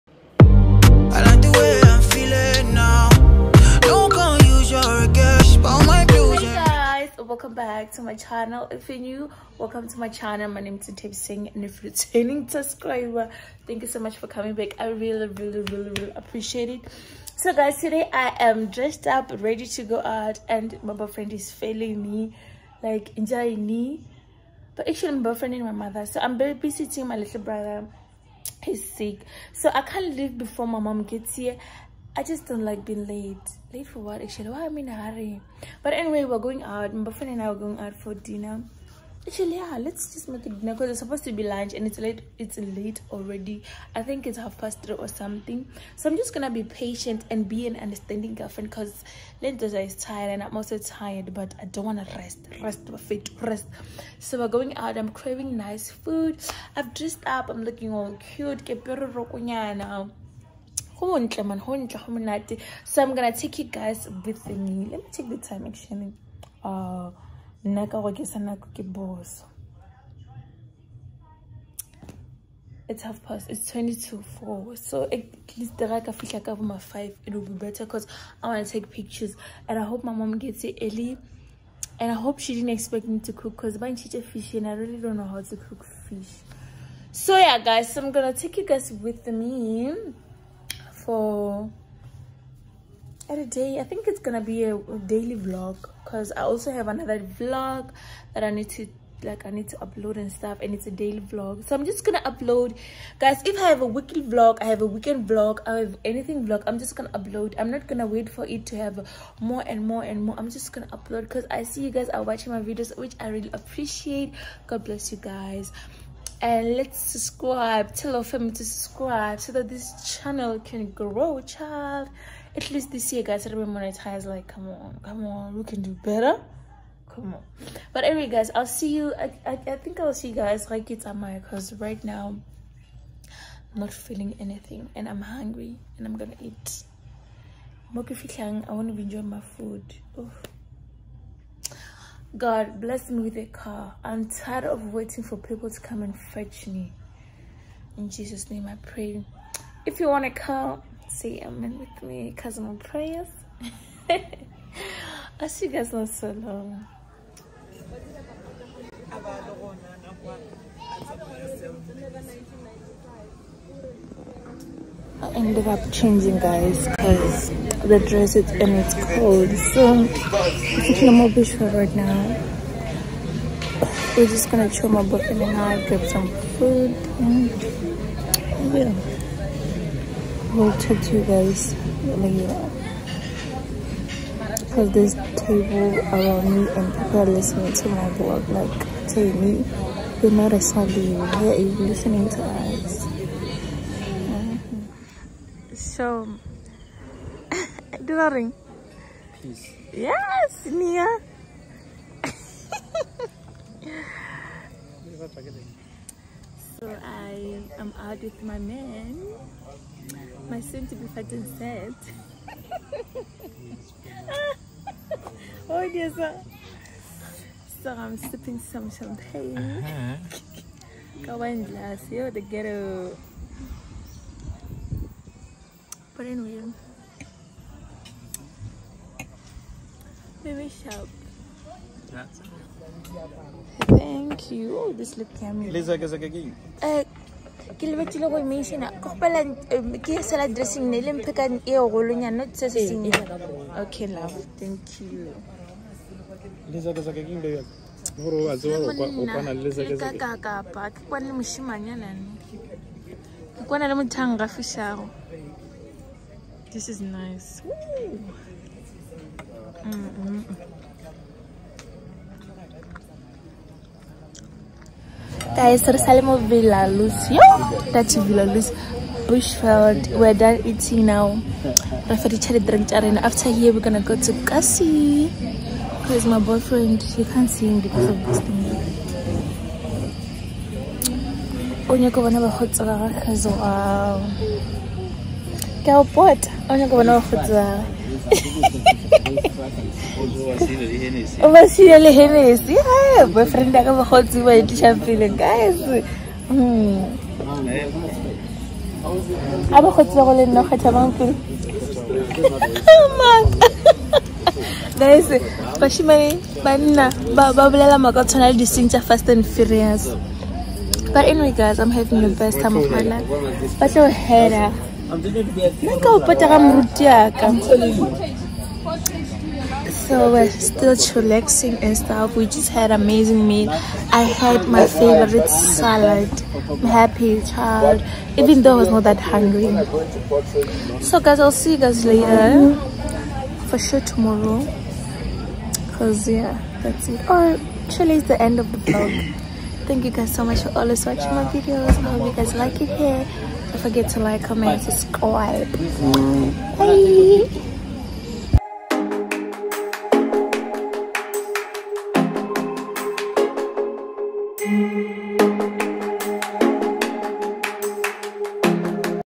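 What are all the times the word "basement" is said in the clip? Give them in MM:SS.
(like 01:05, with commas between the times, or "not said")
not said.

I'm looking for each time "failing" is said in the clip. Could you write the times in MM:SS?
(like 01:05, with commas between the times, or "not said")
00:21.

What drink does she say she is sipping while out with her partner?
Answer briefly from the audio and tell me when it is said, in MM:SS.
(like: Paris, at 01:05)
champagne, at 03:38.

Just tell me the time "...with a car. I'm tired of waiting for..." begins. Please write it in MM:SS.
02:23.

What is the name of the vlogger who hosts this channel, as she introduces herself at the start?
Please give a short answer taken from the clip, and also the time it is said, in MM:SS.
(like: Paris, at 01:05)
Nthabiseng, at 00:10.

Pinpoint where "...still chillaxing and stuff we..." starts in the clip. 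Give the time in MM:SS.
05:20.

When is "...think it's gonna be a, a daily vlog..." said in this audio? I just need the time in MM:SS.
01:33.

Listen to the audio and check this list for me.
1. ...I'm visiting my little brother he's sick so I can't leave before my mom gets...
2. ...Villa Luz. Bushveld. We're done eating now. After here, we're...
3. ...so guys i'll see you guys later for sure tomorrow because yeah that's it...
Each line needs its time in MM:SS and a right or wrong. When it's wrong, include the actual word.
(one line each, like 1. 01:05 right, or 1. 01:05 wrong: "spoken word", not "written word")
1. 00:26 right
2. 04:28 right
3. 05:31 right.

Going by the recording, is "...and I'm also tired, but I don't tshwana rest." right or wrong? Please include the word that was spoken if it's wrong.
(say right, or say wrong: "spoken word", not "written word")
wrong: "wanna", not "tshwana".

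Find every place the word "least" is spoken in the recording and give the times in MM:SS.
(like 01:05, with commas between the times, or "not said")
01:15, 02:02.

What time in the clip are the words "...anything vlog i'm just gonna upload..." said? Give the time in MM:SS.
01:46.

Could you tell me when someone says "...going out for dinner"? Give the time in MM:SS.
00:37.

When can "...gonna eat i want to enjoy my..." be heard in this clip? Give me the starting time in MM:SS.
02:16.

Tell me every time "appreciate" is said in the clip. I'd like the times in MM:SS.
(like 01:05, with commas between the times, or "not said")
00:16, 01:53.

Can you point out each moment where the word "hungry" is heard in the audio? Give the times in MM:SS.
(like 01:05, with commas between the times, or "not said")
02:15, 05:29.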